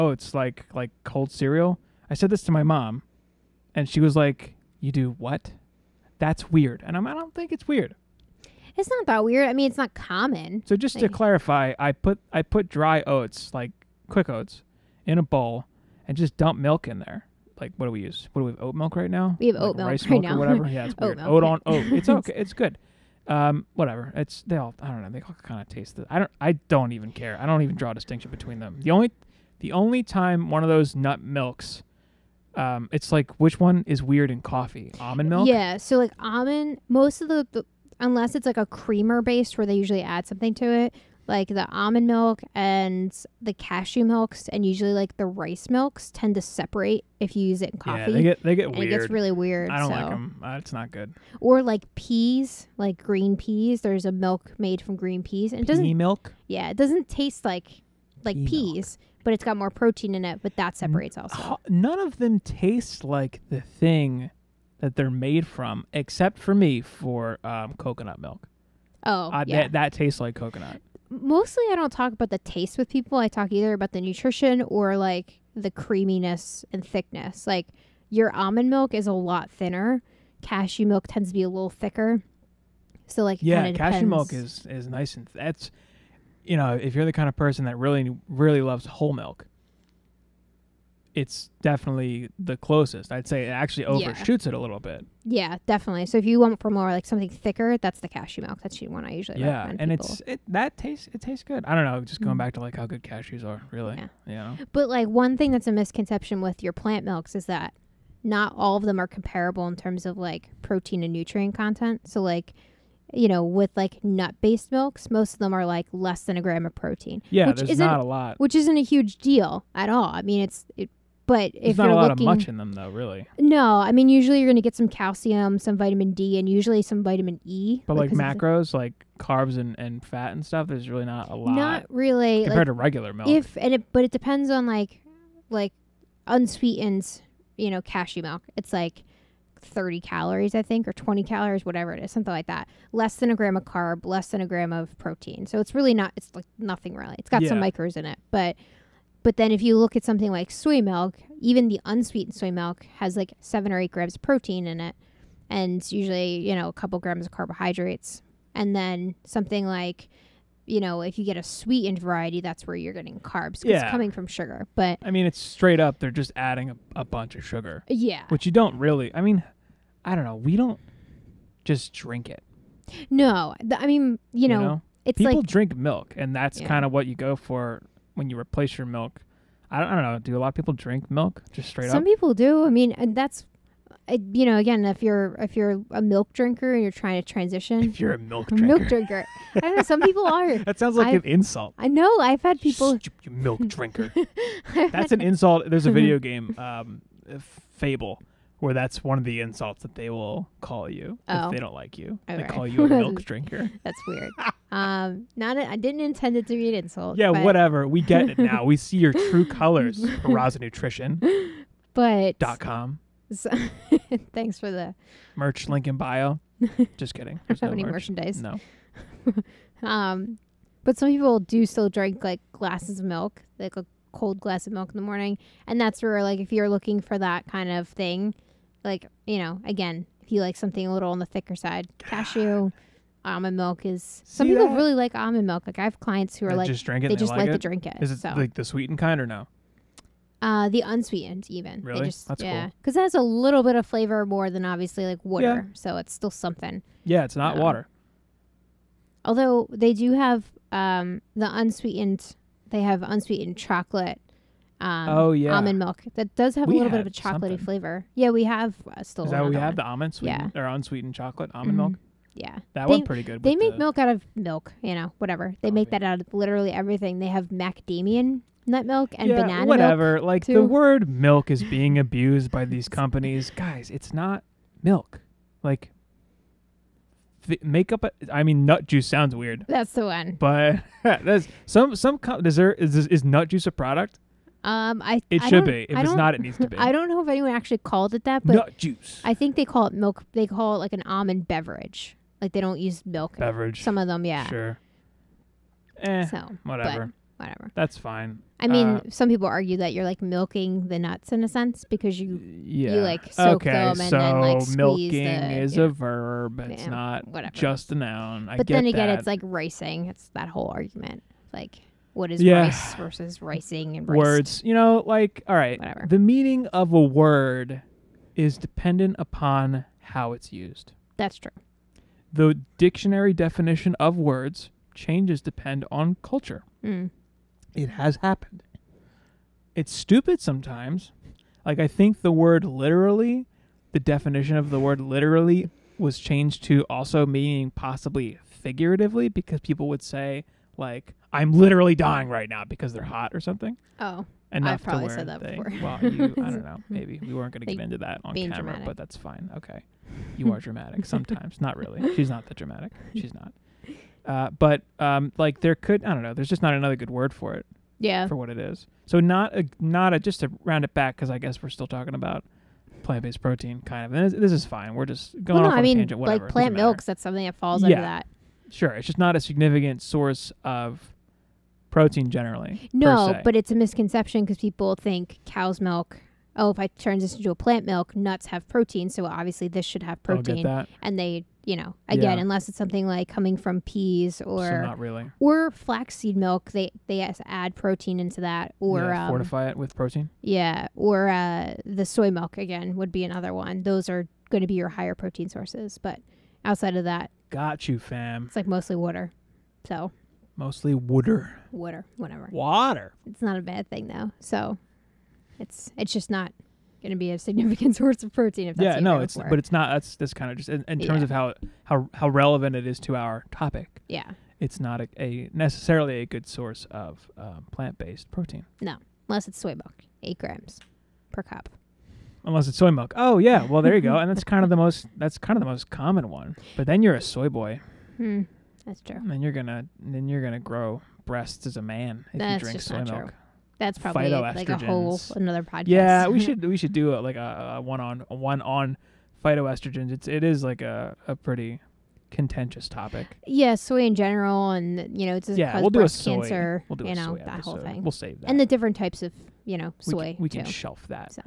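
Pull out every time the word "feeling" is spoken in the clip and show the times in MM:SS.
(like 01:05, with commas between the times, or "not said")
not said.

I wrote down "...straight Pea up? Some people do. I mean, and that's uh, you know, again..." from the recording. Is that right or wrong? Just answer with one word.
wrong.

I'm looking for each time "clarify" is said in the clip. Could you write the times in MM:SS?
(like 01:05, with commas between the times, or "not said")
00:11.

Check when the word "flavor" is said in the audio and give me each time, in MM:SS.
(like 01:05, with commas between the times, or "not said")
04:03, 04:17.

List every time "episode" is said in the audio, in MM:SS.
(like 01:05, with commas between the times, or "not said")
07:27.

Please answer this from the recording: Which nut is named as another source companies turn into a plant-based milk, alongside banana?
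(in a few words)
Macadamia nut.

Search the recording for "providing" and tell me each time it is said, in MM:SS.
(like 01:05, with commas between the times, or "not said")
not said.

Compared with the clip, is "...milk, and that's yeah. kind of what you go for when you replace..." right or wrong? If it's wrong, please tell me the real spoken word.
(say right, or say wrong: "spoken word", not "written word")
right.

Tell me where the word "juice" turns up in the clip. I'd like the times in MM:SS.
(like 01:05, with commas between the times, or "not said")
04:38, 04:43, 04:48.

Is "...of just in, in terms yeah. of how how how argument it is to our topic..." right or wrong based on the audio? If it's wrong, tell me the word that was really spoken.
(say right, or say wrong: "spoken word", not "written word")
wrong: "relevant", not "argument".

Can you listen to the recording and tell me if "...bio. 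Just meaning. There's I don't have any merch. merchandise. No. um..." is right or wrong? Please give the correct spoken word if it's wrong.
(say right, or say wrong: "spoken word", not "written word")
wrong: "kidding", not "meaning".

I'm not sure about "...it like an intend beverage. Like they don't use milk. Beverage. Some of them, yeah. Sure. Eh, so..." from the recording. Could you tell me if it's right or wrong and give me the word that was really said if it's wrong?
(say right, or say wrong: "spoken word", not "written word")
wrong: "almond", not "intend".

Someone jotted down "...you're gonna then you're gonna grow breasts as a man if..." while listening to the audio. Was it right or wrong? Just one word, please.
right.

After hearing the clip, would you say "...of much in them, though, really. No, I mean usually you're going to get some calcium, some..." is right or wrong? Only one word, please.
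right.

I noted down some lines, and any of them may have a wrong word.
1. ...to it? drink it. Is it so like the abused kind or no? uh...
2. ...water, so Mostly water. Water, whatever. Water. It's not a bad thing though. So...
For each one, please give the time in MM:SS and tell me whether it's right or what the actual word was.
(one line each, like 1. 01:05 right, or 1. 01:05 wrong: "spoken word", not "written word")
1. 03:57 wrong: "sweetened", not "abused"
2. 06:38 right.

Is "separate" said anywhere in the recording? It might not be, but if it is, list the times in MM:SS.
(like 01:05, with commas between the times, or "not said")
00:46, 01:00.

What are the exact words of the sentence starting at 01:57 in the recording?
Yeah, which there's isn't, not a lot.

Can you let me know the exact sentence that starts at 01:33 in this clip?
I'd say it actually overshoots yeah.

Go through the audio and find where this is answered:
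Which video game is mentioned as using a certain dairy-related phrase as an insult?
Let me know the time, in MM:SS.
03:17.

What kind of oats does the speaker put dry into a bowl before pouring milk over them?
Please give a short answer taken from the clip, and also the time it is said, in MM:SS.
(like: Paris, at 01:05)
Quick oats, at 00:14.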